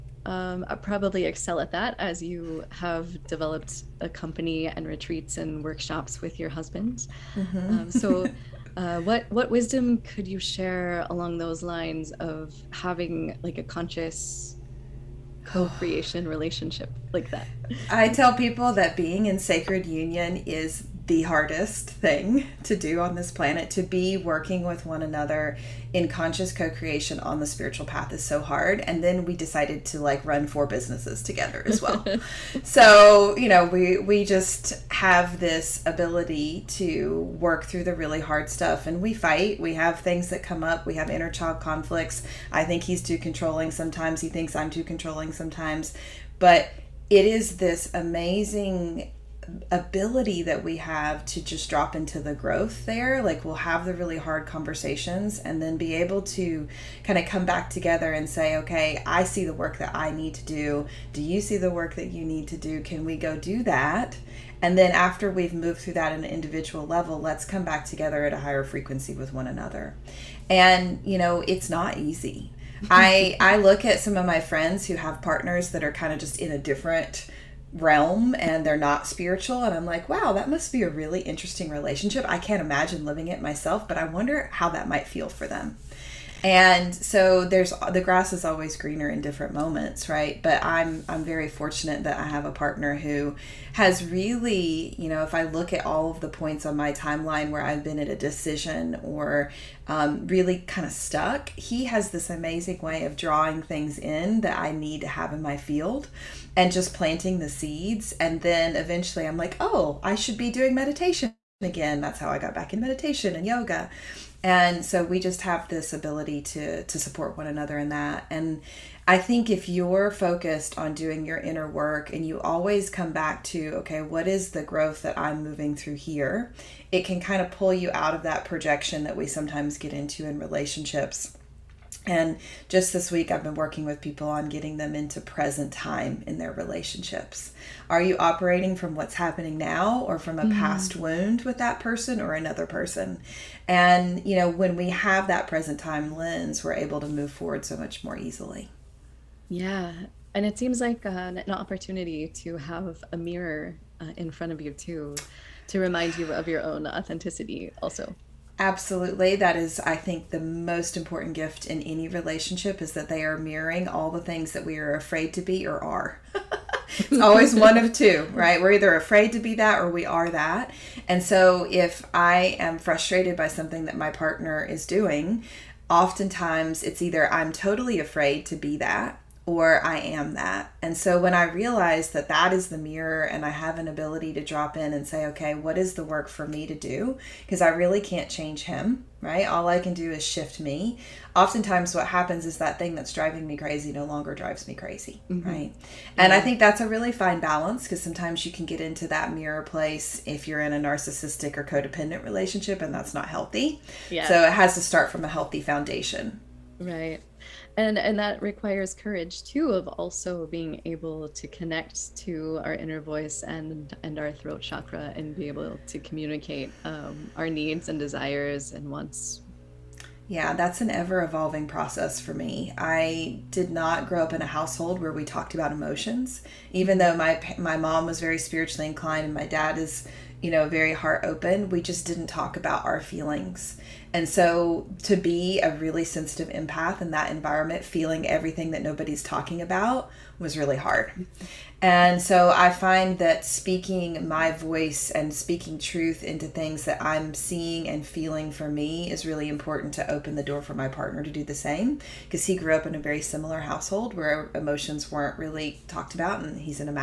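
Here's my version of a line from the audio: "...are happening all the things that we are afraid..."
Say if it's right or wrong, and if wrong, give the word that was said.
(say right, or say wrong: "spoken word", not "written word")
wrong: "mirroring", not "happening".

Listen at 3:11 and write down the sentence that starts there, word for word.
Oftentimes, what happens is that thing that's driving me crazy no longer drives me crazy, mm-hmm.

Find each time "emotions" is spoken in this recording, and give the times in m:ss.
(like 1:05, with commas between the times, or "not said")
3:45, 4:14.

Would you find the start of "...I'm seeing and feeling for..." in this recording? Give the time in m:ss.
4:06.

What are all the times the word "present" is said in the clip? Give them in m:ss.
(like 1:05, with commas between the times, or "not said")
2:15, 2:25.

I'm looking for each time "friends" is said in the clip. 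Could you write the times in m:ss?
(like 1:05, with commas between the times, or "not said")
1:14.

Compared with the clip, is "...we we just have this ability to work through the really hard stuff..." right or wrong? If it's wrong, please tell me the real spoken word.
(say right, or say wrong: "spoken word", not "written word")
right.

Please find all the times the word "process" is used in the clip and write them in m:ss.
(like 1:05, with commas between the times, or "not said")
3:41.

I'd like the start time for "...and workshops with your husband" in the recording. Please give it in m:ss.
0:05.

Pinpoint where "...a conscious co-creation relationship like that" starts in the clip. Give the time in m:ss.
0:13.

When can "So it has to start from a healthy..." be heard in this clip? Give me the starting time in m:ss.
3:24.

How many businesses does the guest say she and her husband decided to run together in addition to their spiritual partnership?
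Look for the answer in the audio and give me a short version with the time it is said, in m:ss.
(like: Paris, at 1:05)
4, at 0:30.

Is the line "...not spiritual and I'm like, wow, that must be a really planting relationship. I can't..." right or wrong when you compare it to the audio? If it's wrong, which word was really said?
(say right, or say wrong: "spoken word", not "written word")
wrong: "interesting", not "planting".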